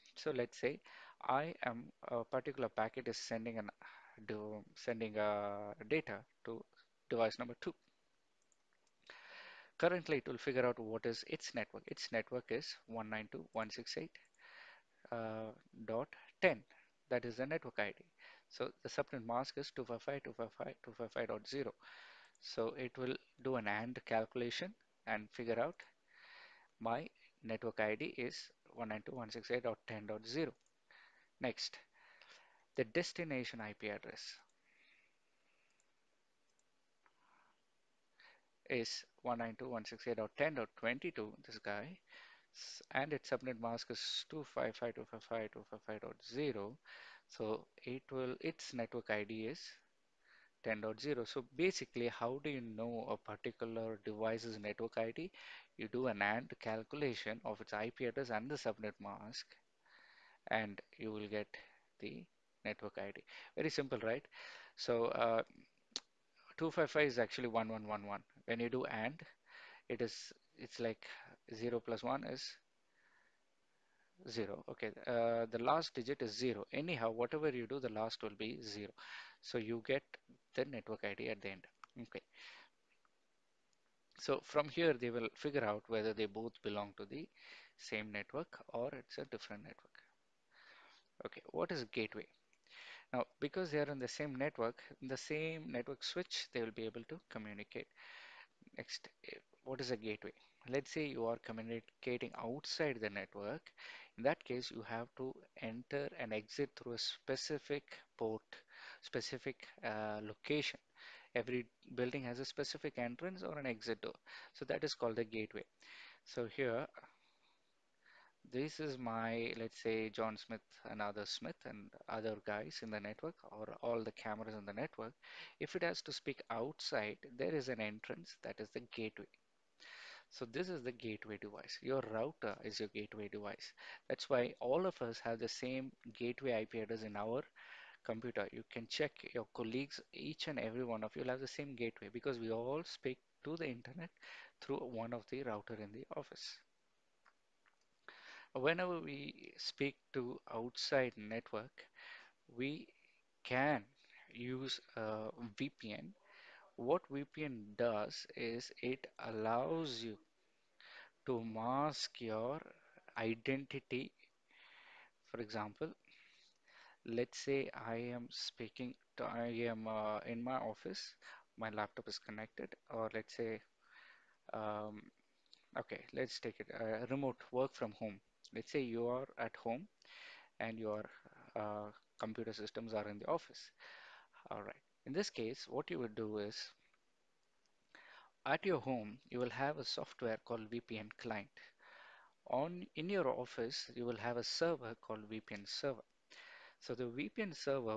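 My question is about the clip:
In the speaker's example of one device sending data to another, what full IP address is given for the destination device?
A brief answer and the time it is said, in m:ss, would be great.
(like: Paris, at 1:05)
192.168.10.22, at 0:39.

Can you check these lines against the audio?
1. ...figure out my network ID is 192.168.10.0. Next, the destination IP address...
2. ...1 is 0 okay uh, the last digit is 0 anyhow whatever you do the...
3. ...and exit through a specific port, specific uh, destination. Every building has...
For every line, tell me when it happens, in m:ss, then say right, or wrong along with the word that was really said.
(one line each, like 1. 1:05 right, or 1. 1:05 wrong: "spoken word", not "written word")
1. 0:25 right
2. 1:12 right
3. 1:46 wrong: "location", not "destination".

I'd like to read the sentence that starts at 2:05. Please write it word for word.
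If it has to speak outside, there is an entrance that is the gateway.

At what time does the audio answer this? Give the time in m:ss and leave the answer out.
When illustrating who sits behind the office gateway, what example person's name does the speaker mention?
2:00.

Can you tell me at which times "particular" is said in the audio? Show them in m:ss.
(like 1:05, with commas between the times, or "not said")
0:02, 0:53.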